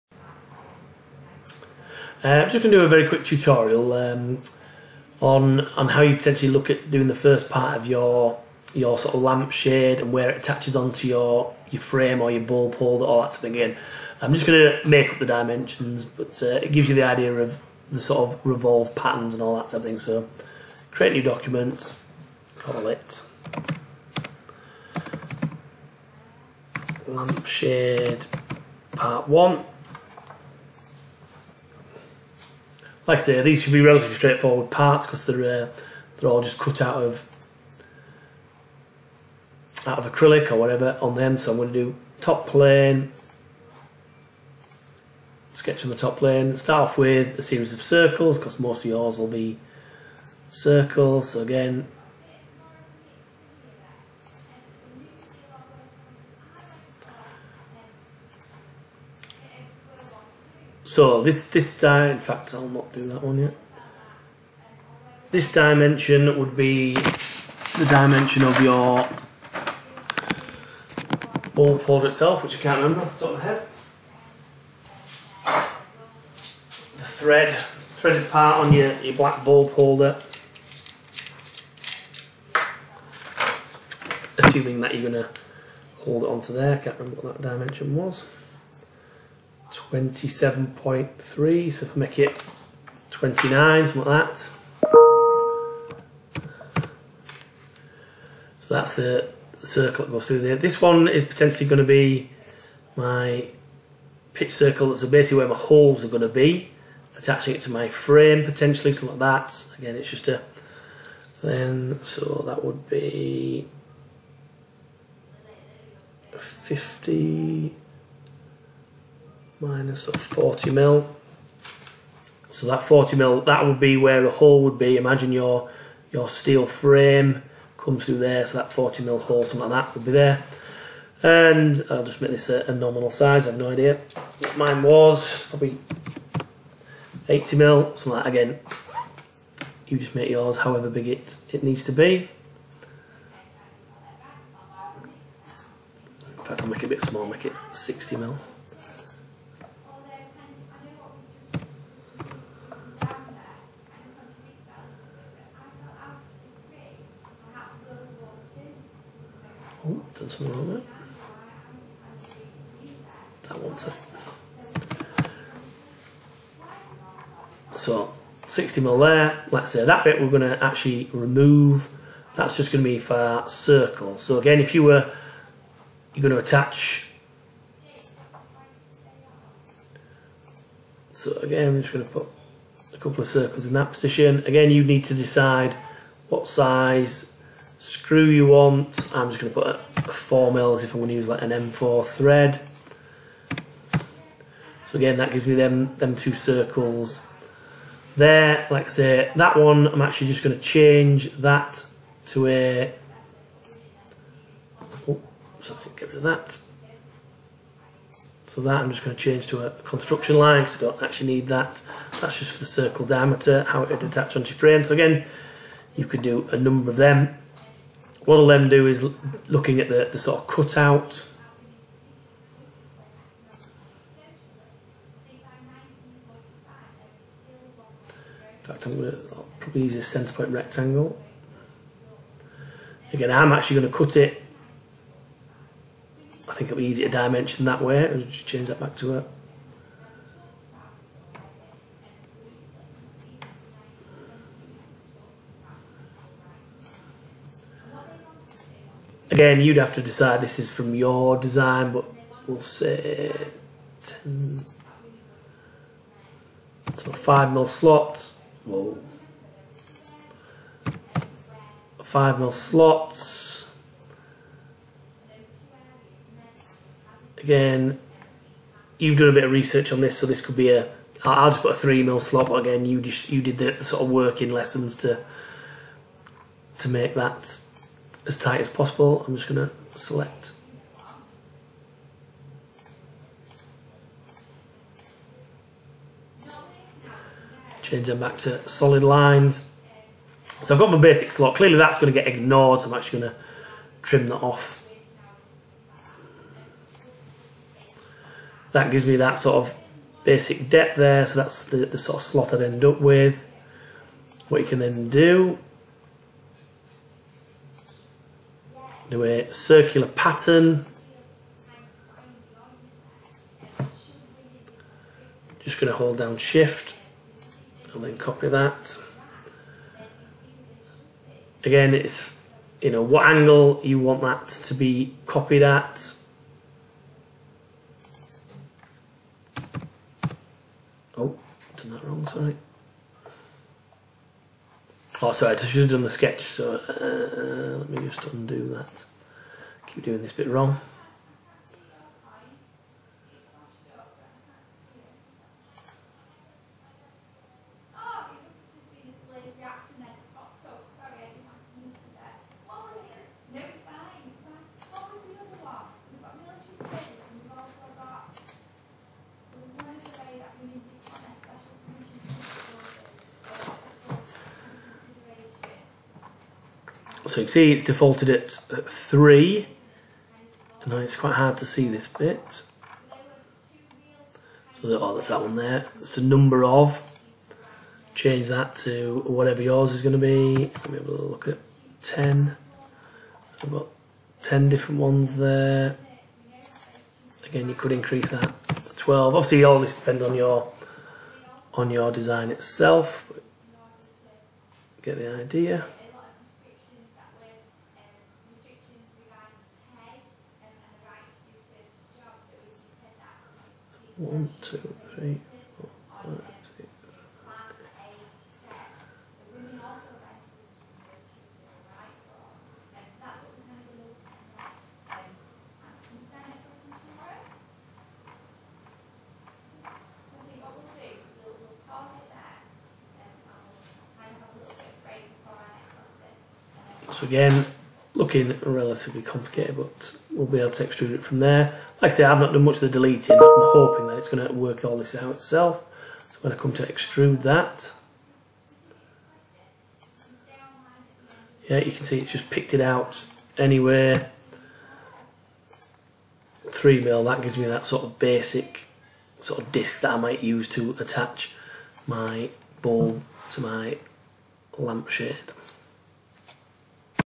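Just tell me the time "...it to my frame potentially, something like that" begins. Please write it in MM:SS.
01:47.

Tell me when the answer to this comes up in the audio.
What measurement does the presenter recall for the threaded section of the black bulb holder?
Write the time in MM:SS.
01:29.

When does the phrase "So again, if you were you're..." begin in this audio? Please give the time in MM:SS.
02:54.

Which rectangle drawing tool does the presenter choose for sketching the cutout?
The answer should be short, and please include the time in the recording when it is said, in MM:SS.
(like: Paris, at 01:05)
centre point rectangle, at 03:50.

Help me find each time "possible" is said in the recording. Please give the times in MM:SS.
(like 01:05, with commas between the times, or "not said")
04:38.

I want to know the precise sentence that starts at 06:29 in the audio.
Obviously, all this depends on your on your design itself.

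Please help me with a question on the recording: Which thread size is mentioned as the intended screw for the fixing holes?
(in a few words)
M4.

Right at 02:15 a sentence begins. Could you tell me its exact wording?
Probably 80 mil, something like that.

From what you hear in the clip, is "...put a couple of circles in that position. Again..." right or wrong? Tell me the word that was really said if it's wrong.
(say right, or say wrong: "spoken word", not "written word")
right.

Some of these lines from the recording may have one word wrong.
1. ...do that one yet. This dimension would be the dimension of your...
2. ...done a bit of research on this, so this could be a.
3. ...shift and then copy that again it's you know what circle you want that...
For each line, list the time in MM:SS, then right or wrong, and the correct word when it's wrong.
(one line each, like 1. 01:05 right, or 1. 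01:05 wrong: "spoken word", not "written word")
1. 01:02 right
2. 04:29 right
3. 05:16 wrong: "angle", not "circle".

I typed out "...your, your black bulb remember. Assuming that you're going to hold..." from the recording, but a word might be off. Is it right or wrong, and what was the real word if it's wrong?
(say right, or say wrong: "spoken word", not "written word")
wrong: "holder", not "remember".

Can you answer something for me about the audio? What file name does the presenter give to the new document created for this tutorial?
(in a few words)
lampshade part one.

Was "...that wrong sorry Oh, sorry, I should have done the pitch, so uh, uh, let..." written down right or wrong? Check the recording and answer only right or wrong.
wrong.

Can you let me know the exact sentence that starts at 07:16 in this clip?
So when I come to extrude that, yeah, you can see it's just picked it out anywhere.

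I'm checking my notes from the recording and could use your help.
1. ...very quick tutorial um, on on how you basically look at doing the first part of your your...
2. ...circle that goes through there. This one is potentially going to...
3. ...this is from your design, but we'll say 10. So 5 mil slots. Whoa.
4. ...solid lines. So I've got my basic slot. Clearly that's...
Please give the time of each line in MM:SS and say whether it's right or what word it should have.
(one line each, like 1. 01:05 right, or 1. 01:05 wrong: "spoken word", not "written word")
1. 00:02 wrong: "potentially", not "basically"
2. 01:39 right
3. 04:10 right
4. 04:48 right.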